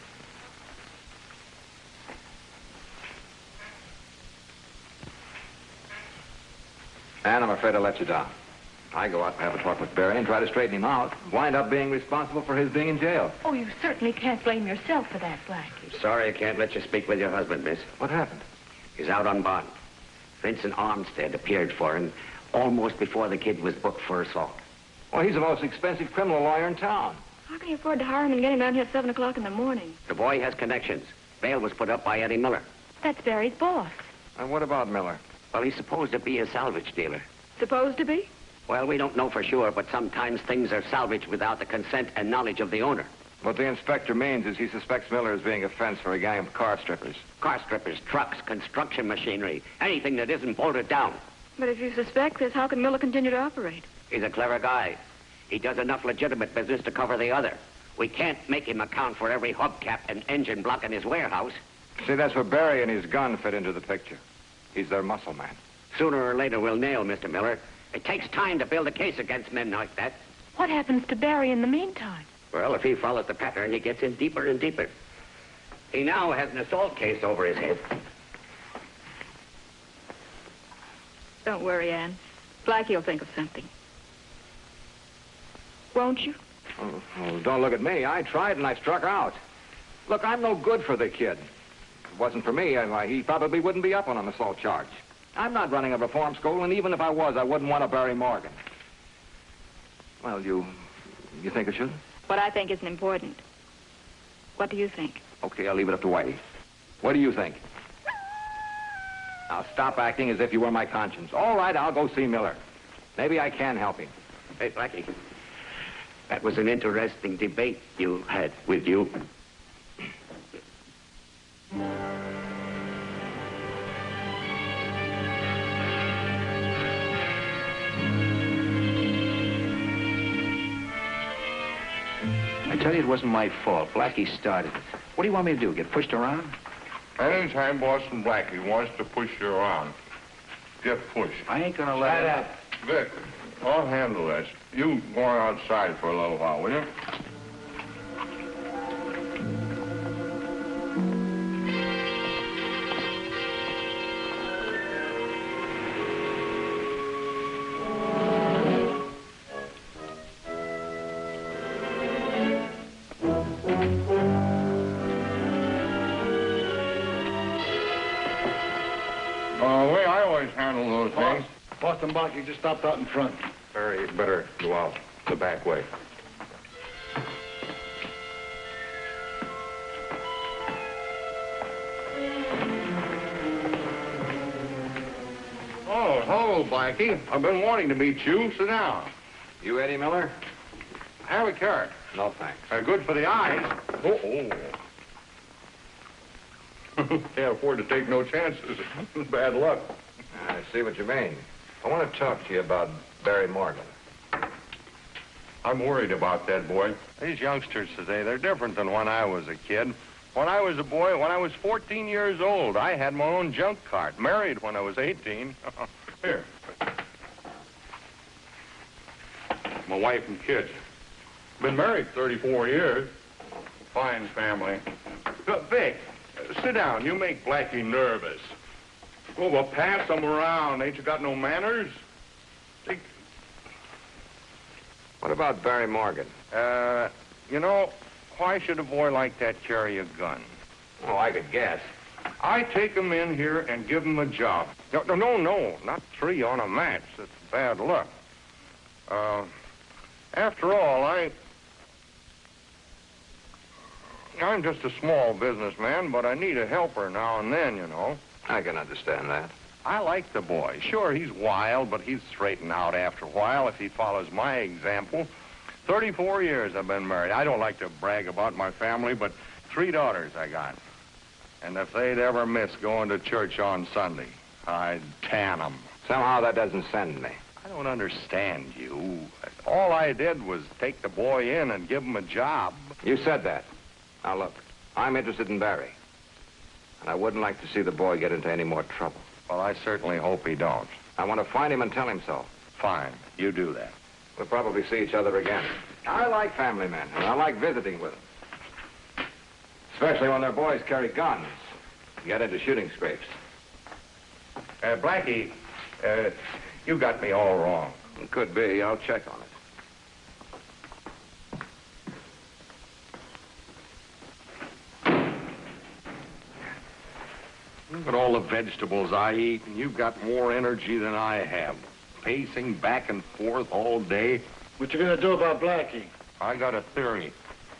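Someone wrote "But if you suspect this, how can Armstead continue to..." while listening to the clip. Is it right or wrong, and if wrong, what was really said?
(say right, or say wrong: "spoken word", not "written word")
wrong: "Miller", not "Armstead".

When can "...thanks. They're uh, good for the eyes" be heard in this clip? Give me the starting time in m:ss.
3:12.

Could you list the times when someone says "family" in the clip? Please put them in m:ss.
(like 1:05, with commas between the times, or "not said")
3:44, 4:28, 4:56.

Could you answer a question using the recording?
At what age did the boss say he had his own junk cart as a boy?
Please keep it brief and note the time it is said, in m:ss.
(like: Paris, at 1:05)
14, at 3:31.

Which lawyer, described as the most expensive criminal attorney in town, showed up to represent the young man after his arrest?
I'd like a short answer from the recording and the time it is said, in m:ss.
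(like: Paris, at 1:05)
Vincent Armstead, at 0:20.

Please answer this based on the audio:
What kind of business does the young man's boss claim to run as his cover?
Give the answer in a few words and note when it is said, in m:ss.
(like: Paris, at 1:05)
salvage dealer, at 0:36.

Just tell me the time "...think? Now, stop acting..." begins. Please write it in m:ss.
1:47.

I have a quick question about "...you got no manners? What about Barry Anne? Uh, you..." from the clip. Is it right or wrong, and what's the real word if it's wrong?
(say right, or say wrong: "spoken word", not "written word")
wrong: "Morgan", not "Anne".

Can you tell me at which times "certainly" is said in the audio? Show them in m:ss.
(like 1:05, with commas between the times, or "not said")
0:13, 4:49.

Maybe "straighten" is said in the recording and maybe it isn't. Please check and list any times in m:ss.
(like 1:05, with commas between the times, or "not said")
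0:10, 4:22.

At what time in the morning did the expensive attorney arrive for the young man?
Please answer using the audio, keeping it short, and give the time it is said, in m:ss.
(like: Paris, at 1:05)
7 o'clock, at 0:28.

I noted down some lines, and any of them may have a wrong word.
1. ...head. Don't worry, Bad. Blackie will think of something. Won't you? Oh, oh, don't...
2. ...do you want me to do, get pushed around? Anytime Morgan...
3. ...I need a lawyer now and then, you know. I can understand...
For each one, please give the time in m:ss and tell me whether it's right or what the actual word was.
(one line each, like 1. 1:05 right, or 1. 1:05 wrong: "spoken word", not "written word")
1. 1:17 wrong: "Anne", not "Bad"
2. 2:15 wrong: "Boston", not "Morgan"
3. 4:16 wrong: "helper", not "lawyer".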